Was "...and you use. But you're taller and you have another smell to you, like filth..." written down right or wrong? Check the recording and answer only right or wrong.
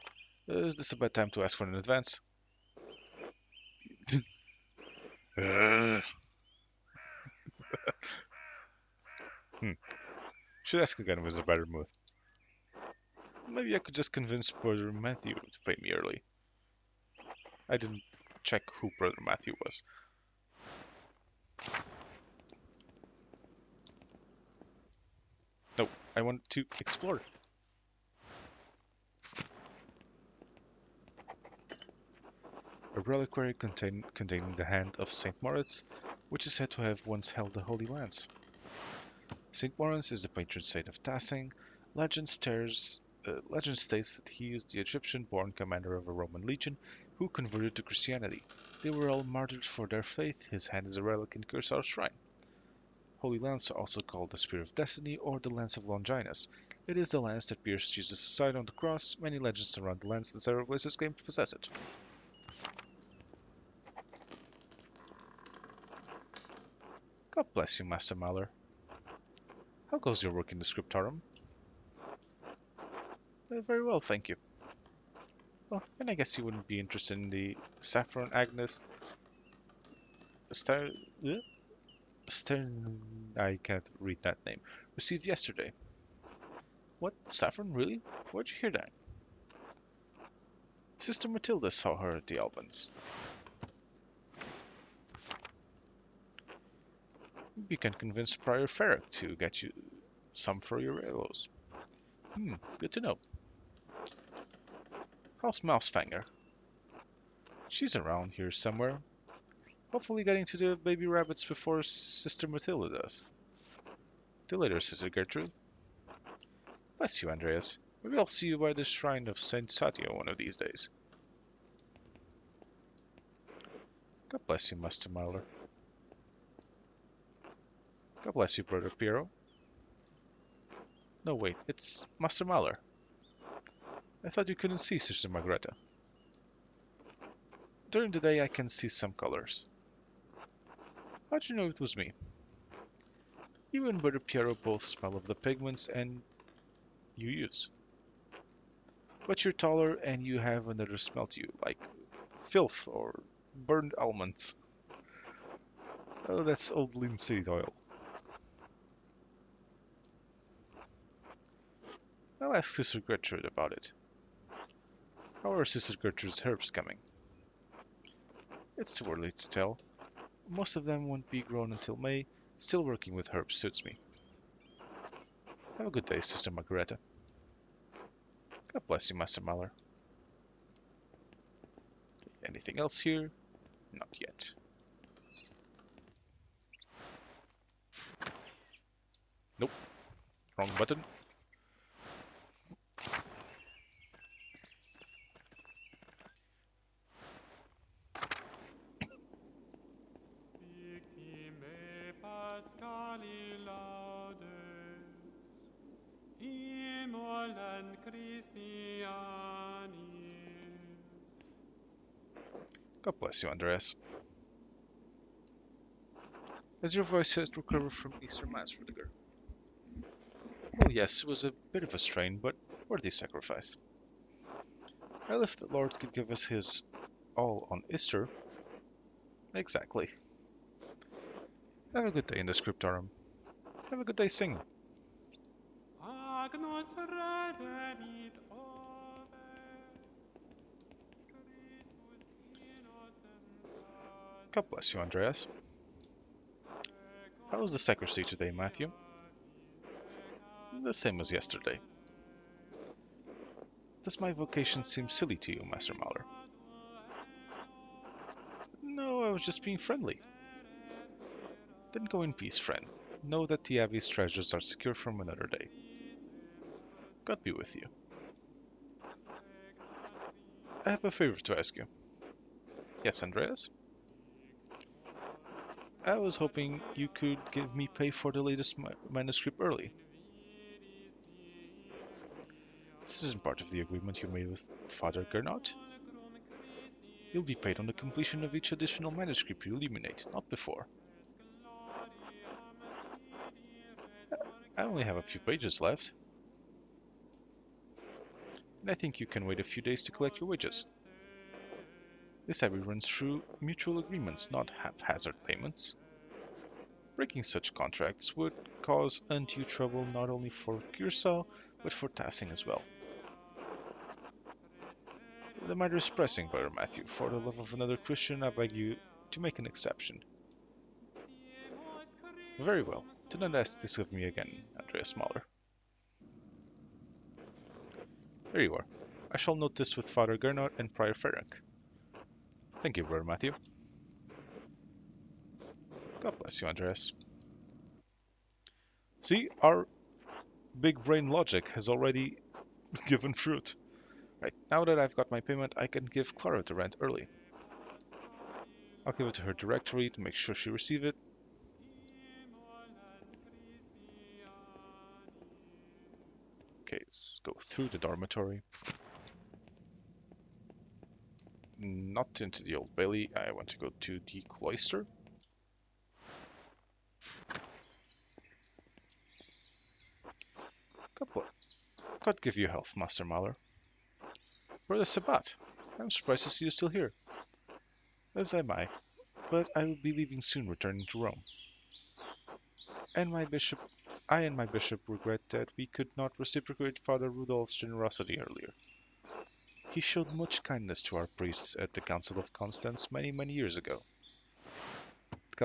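right.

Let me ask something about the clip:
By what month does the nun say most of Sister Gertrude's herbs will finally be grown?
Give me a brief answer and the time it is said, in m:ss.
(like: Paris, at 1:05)
May, at 2:51.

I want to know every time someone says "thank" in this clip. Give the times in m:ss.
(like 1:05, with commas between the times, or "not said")
1:14, 5:32.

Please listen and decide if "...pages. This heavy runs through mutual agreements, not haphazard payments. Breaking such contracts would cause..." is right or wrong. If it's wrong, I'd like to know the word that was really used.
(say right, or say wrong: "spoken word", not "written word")
wrong: "wages", not "pages".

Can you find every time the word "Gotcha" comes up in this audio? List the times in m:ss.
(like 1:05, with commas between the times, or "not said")
not said.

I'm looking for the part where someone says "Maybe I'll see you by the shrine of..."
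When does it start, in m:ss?
1:58.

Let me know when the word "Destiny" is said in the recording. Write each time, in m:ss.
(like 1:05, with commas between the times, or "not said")
0:54.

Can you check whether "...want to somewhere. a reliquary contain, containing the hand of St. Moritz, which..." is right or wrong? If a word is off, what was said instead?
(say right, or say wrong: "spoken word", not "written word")
wrong: "explore", not "somewhere".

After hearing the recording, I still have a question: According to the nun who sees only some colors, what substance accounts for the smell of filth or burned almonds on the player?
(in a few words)
Linseed oil.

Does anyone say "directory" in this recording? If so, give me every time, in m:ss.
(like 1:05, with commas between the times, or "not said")
5:49.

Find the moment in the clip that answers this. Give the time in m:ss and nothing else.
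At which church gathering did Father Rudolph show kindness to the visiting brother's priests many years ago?
6:32.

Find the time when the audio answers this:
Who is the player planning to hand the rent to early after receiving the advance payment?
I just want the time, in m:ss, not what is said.
5:46.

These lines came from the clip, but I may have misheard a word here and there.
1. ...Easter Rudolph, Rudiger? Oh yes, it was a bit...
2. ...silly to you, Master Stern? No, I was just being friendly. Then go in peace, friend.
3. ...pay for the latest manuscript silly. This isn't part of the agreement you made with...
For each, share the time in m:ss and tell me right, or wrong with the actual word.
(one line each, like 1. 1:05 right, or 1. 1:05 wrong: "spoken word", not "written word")
1. 3:38 wrong: "Mass", not "Rudolph"
2. 4:15 wrong: "Mahler", not "Stern"
3. 4:37 wrong: "early", not "silly".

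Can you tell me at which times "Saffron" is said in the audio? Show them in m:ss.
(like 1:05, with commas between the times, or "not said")
1:17, 1:27.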